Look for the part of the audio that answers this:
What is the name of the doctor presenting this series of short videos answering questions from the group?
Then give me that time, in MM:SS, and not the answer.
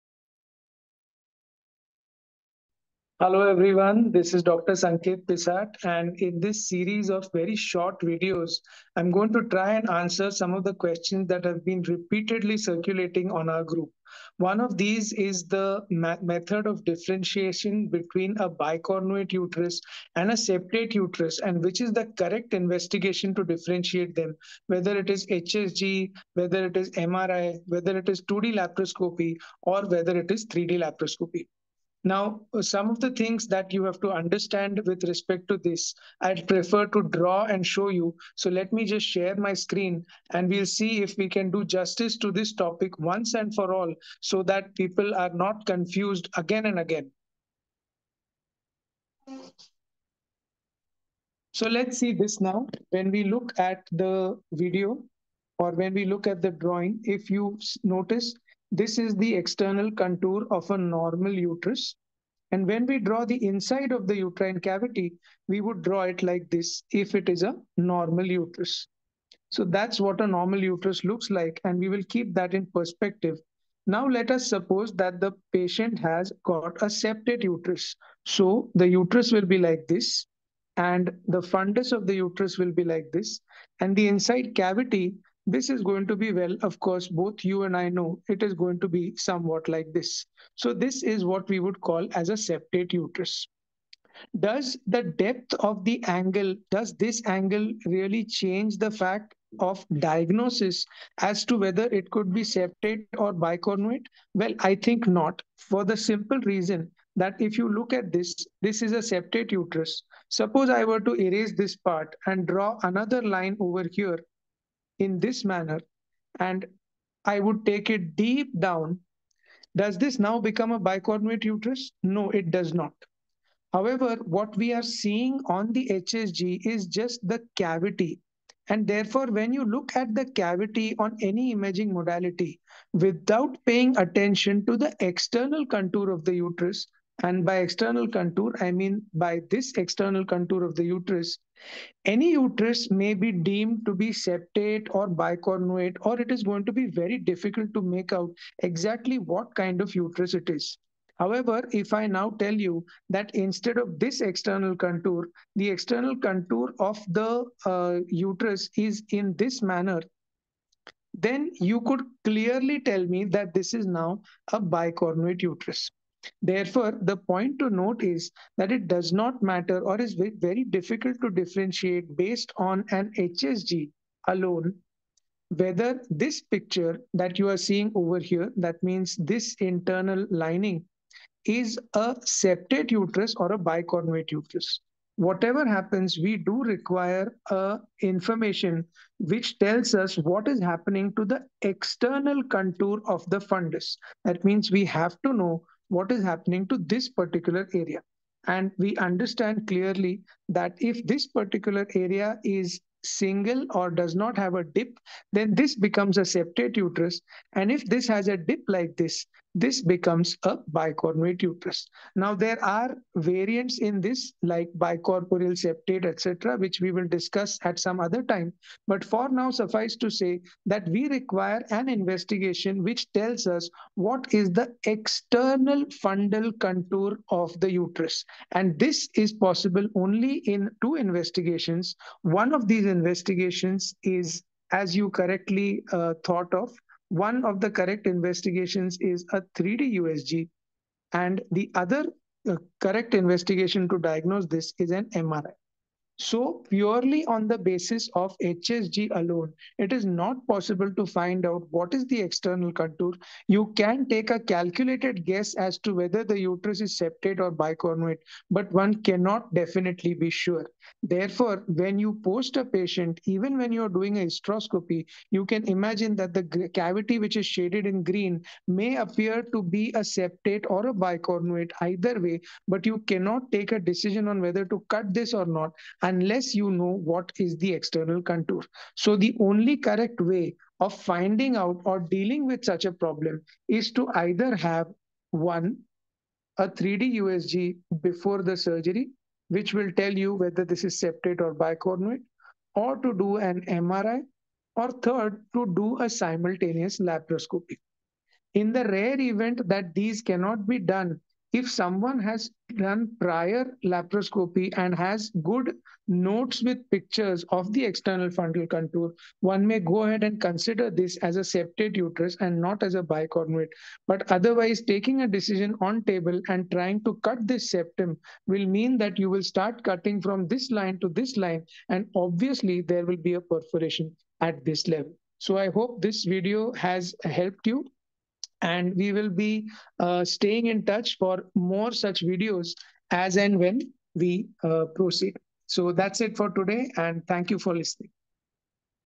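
00:04.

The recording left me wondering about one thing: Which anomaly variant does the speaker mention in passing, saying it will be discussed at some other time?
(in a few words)
Bicorporeal septate.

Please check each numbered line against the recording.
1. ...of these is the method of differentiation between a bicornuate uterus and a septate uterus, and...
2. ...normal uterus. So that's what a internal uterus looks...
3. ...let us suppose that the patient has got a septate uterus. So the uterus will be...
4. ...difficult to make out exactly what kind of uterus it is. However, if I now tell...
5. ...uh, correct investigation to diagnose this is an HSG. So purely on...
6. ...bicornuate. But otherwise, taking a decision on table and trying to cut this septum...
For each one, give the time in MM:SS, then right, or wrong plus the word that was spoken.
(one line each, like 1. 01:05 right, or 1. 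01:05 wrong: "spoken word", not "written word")
1. 00:14 right
2. 01:07 wrong: "normal", not "internal"
3. 01:14 right
4. 02:27 right
5. 04:02 wrong: "MRI", not "HSG"
6. 05:13 right.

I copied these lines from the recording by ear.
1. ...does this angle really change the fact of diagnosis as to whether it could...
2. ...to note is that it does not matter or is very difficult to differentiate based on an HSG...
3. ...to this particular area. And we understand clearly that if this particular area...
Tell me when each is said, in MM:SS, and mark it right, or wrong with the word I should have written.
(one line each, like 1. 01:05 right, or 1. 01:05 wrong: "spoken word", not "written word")
1. 01:36 right
2. 02:47 right
3. 03:16 right.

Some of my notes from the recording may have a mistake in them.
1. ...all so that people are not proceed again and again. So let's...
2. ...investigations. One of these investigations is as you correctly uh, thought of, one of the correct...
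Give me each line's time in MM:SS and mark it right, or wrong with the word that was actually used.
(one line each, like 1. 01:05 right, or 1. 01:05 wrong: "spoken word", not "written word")
1. 00:43 wrong: "confused", not "proceed"
2. 03:50 right.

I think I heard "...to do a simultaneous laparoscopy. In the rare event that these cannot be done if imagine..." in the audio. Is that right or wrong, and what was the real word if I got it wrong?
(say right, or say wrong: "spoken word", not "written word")
wrong: "someone", not "imagine".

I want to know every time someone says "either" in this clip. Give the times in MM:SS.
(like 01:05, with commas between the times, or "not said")
04:31, 04:44.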